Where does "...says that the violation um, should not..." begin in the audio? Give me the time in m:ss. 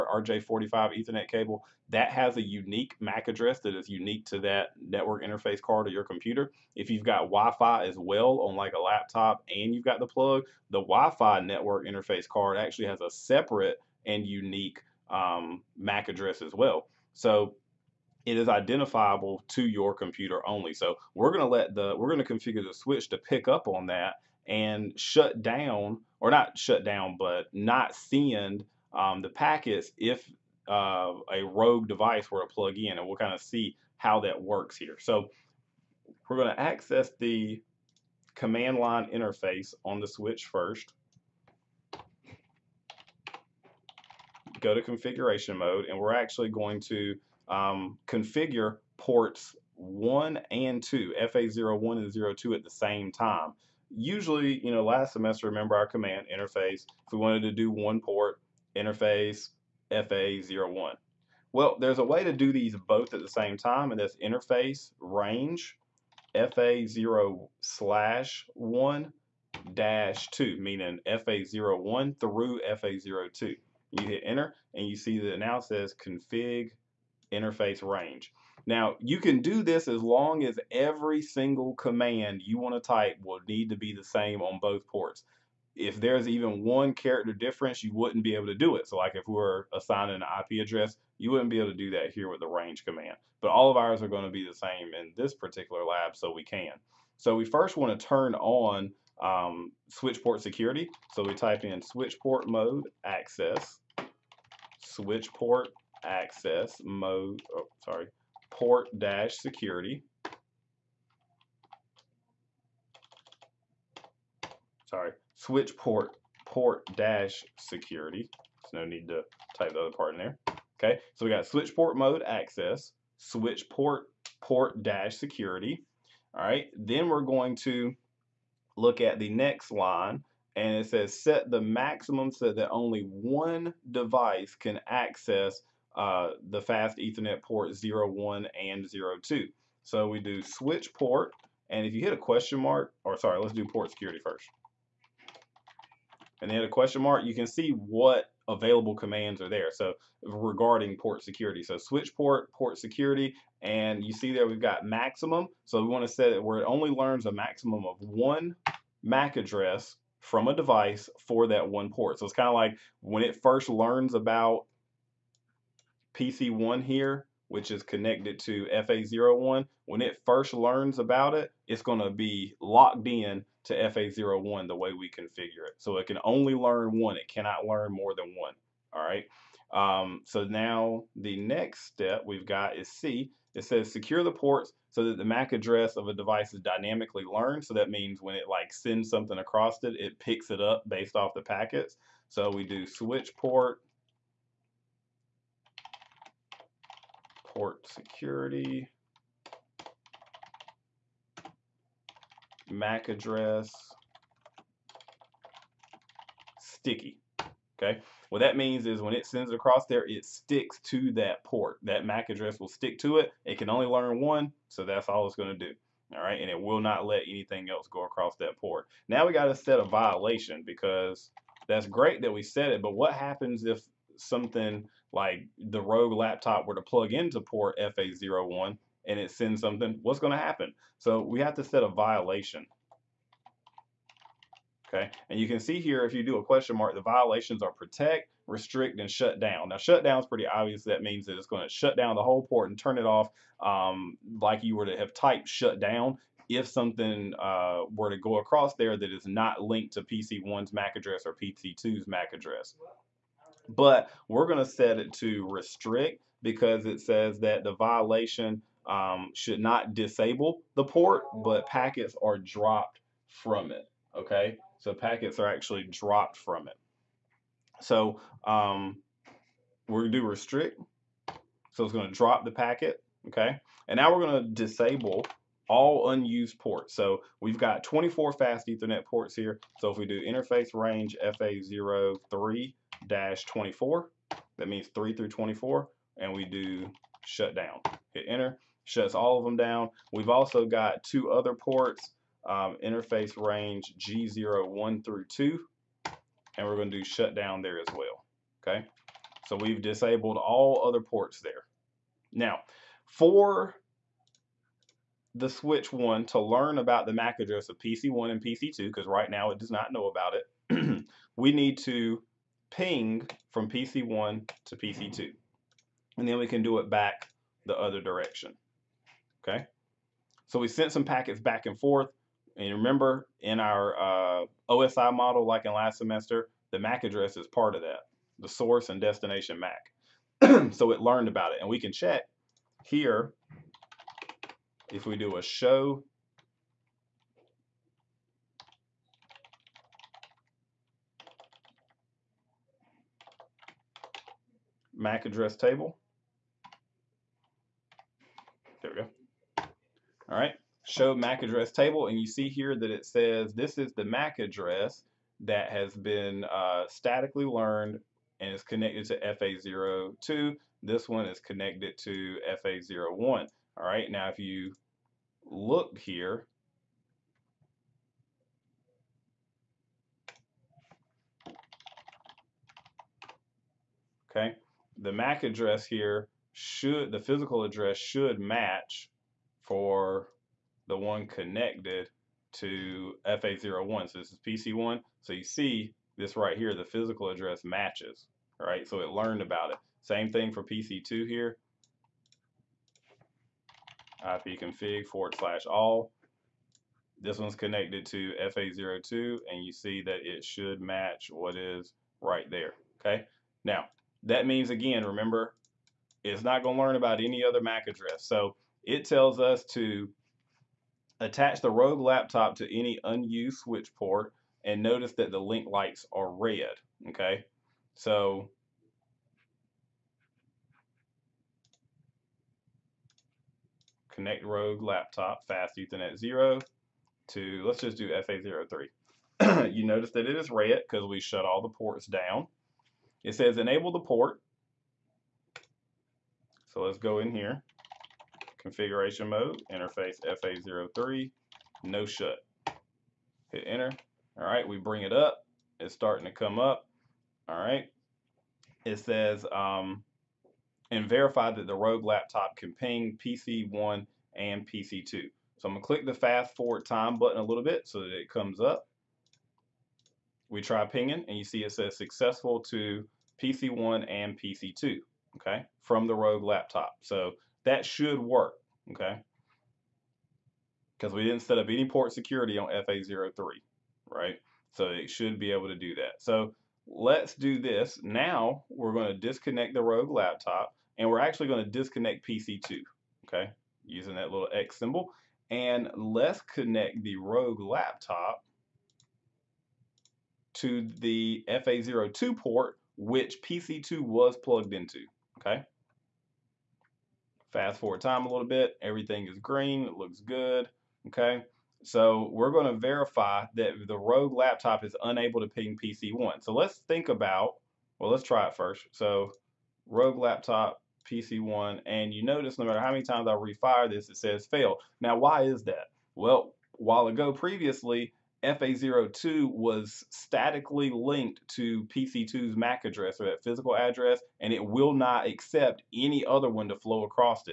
4:17.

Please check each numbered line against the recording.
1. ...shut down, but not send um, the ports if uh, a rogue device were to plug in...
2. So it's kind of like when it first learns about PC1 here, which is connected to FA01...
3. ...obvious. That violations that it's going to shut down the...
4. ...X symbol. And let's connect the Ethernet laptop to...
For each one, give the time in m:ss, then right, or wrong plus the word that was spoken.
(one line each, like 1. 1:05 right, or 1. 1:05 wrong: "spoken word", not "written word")
1. 0:26 wrong: "packets", not "ports"
2. 2:42 right
3. 4:00 wrong: "means", not "violations"
4. 8:04 wrong: "Rogue", not "Ethernet".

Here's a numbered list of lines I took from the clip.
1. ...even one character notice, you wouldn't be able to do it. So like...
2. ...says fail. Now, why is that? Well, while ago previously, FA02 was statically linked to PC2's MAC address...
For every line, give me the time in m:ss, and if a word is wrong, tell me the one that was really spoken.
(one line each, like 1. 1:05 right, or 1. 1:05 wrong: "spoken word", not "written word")
1. 1:26 wrong: "difference", not "notice"
2. 8:34 right.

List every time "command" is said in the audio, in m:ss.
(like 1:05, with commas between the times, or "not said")
0:38, 0:55, 1:21, 1:32, 2:28.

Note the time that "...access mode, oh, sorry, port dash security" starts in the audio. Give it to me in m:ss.
1:46.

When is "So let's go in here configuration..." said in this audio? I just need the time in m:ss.
7:16.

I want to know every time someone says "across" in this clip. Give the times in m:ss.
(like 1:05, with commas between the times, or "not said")
3:09, 3:29, 3:38, 4:08, 8:47.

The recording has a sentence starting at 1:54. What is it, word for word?
Sorry, switch port port dash security.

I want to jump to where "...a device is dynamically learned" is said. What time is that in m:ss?
3:06.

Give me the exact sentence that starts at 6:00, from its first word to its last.
This one is connected to FA01.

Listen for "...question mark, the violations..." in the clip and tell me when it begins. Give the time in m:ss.
3:56.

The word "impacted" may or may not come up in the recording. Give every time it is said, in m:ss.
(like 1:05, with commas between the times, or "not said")
not said.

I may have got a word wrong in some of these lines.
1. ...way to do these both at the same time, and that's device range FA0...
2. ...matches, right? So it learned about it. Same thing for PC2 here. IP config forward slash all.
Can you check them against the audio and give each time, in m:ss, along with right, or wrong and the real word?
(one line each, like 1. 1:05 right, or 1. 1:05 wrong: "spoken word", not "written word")
1. 1:02 wrong: "interface", not "device"
2. 6:27 right.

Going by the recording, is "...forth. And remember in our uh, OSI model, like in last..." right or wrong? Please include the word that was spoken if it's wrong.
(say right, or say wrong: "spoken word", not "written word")
right.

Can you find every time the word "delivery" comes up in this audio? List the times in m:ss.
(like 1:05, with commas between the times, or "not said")
not said.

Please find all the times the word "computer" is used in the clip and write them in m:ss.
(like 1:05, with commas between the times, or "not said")
0:06, 0:19.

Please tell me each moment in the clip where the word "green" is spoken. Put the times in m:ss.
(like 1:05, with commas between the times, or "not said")
8:19.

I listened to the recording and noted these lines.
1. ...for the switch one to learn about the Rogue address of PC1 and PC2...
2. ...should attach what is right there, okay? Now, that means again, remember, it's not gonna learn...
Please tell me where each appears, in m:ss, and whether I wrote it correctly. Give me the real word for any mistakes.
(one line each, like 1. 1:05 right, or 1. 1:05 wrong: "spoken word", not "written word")
1. 5:03 wrong: "MAC", not "Rogue"
2. 6:40 wrong: "match", not "attach".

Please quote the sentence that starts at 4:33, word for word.
Okay, and now we're going to disable all unused ports.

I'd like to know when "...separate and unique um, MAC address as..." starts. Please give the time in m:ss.
0:13.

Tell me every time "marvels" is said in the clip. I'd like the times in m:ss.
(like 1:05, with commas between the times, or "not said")
not said.